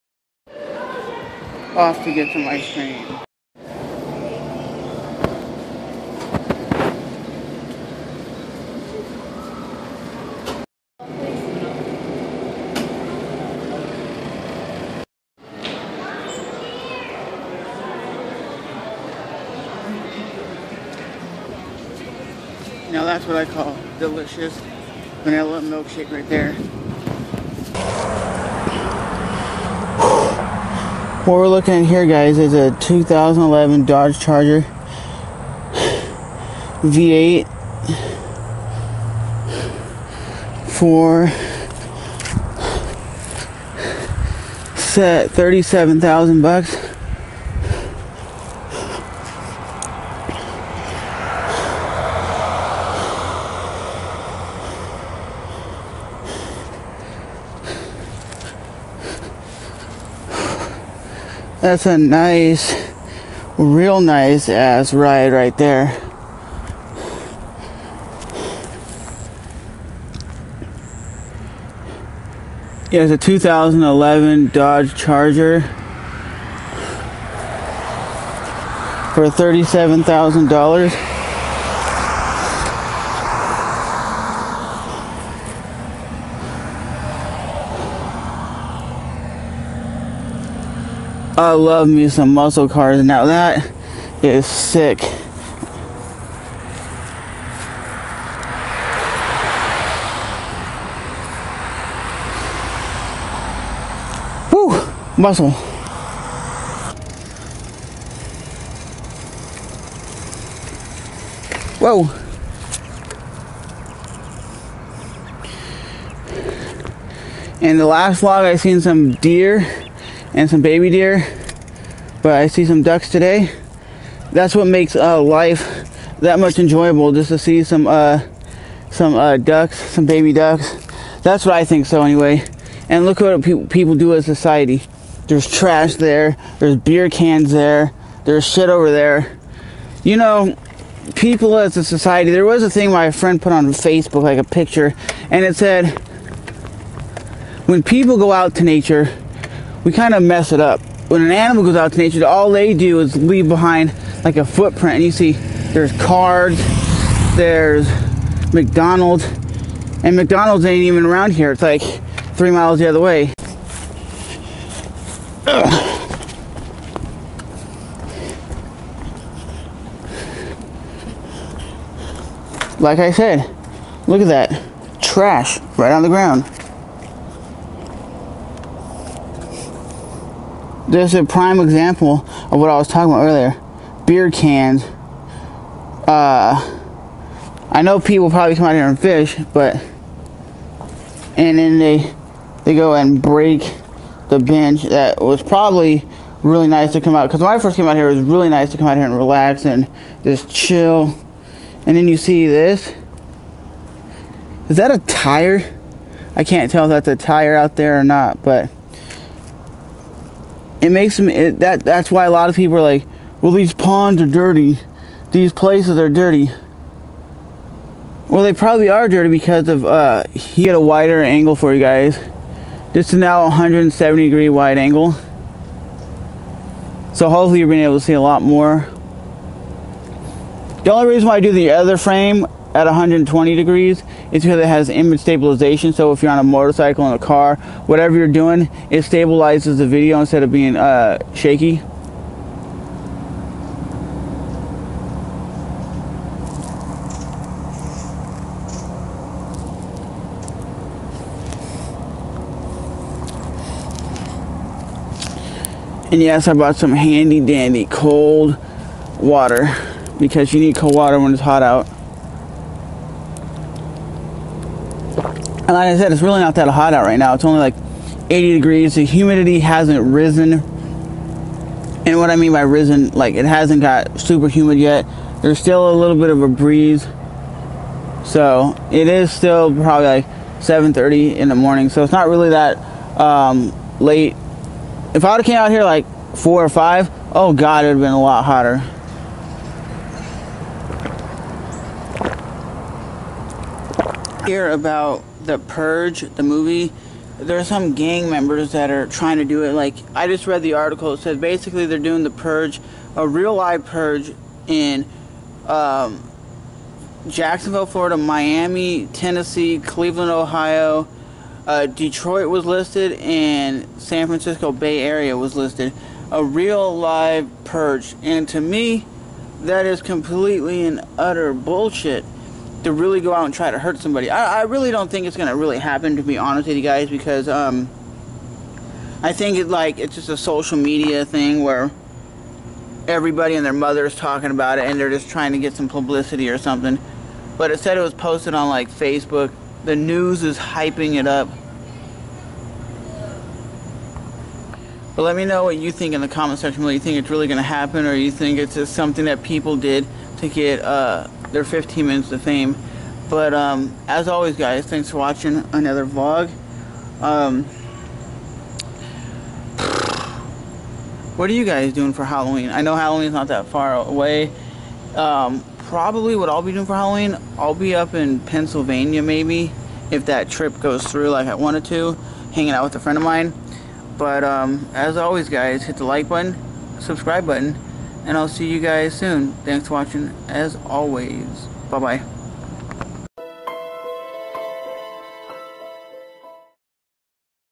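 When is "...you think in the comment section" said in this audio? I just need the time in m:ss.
5:45.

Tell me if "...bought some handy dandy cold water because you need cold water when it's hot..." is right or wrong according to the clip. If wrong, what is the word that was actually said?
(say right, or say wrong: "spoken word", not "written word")
right.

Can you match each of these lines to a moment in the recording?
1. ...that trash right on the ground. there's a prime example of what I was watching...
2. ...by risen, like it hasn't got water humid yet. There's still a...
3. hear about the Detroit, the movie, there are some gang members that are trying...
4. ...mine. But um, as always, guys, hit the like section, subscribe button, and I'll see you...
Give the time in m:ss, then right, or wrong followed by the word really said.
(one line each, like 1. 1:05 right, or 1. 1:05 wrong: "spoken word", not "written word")
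1. 2:54 wrong: "talking", not "watching"
2. 4:32 wrong: "super", not "water"
3. 4:54 wrong: "Purge", not "Detroit"
4. 6:13 wrong: "button", not "section".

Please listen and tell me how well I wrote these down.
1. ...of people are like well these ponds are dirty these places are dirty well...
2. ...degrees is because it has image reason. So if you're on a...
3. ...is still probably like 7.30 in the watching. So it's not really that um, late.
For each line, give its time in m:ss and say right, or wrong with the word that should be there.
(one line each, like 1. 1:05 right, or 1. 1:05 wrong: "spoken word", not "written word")
1. 3:32 right
2. 3:53 wrong: "stabilization", not "reason"
3. 4:39 wrong: "morning", not "watching".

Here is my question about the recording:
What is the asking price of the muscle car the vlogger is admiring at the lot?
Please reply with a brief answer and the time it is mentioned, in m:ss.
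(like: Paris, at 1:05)
$37,000, at 0:45.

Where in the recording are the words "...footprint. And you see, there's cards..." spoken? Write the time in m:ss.
2:34.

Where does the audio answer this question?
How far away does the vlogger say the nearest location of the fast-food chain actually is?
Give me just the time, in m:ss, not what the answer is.
2:42.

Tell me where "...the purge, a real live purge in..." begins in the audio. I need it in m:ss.
5:02.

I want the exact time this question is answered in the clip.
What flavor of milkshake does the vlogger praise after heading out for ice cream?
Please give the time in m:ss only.
0:25.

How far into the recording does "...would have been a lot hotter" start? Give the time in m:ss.
4:47.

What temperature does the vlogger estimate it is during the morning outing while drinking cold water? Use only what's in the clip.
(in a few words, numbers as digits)
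80 degrees.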